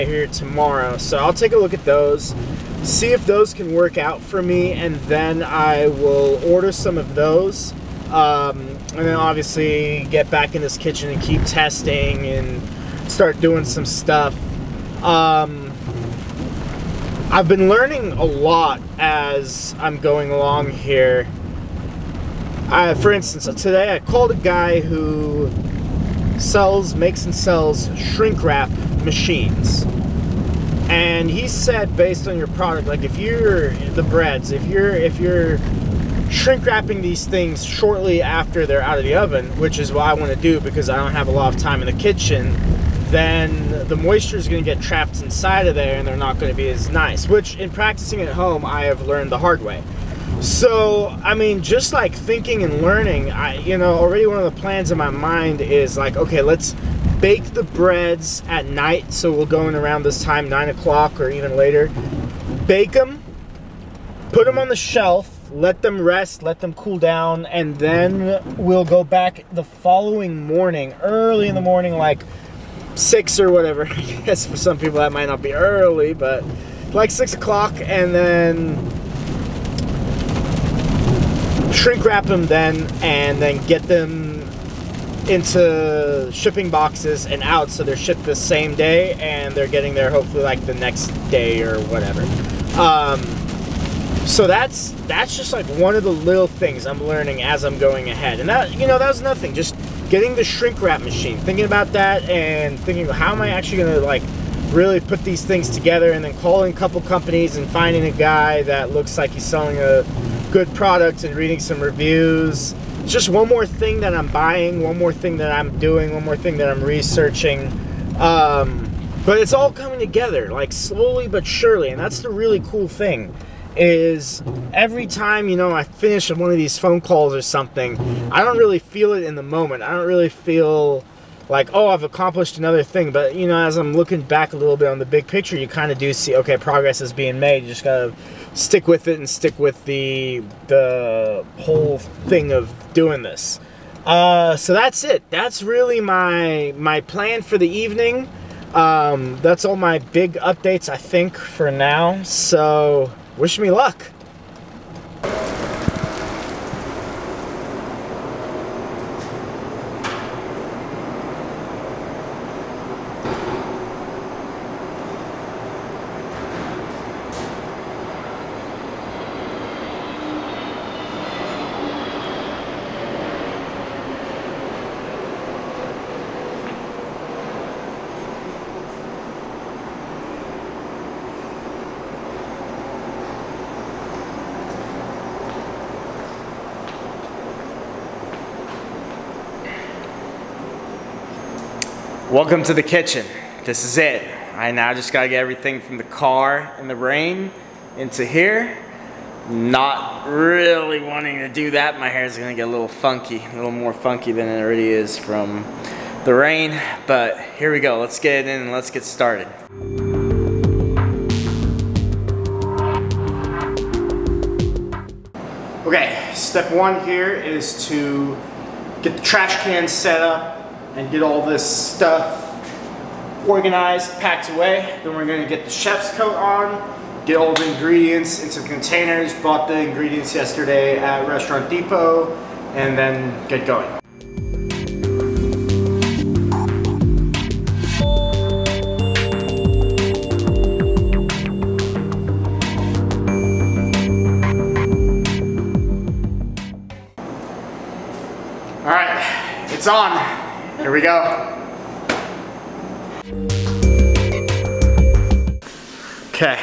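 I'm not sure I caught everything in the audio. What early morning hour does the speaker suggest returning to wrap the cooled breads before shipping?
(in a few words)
6 o'clock.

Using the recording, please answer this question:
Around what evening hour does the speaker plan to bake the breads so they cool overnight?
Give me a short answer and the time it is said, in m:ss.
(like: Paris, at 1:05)
9 o'clock, at 1:00.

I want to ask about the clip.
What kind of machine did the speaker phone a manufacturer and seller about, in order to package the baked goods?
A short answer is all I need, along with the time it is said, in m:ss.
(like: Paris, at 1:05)
Shrink wrap machines, at 0:27.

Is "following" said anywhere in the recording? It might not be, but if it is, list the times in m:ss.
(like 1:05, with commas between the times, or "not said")
1:09.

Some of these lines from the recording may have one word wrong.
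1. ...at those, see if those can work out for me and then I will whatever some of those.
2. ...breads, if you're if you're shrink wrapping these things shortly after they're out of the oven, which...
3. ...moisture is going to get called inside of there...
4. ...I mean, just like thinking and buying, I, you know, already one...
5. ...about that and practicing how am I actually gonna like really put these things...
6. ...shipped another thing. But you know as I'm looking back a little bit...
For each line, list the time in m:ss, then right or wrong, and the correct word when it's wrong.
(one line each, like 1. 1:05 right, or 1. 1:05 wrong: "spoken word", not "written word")
1. 0:01 wrong: "order", not "whatever"
2. 0:34 right
3. 0:43 wrong: "trapped", not "called"
4. 0:51 wrong: "learning", not "buying"
5. 1:41 wrong: "thinking", not "practicing"
6. 2:12 wrong: "accomplished", not "shipped".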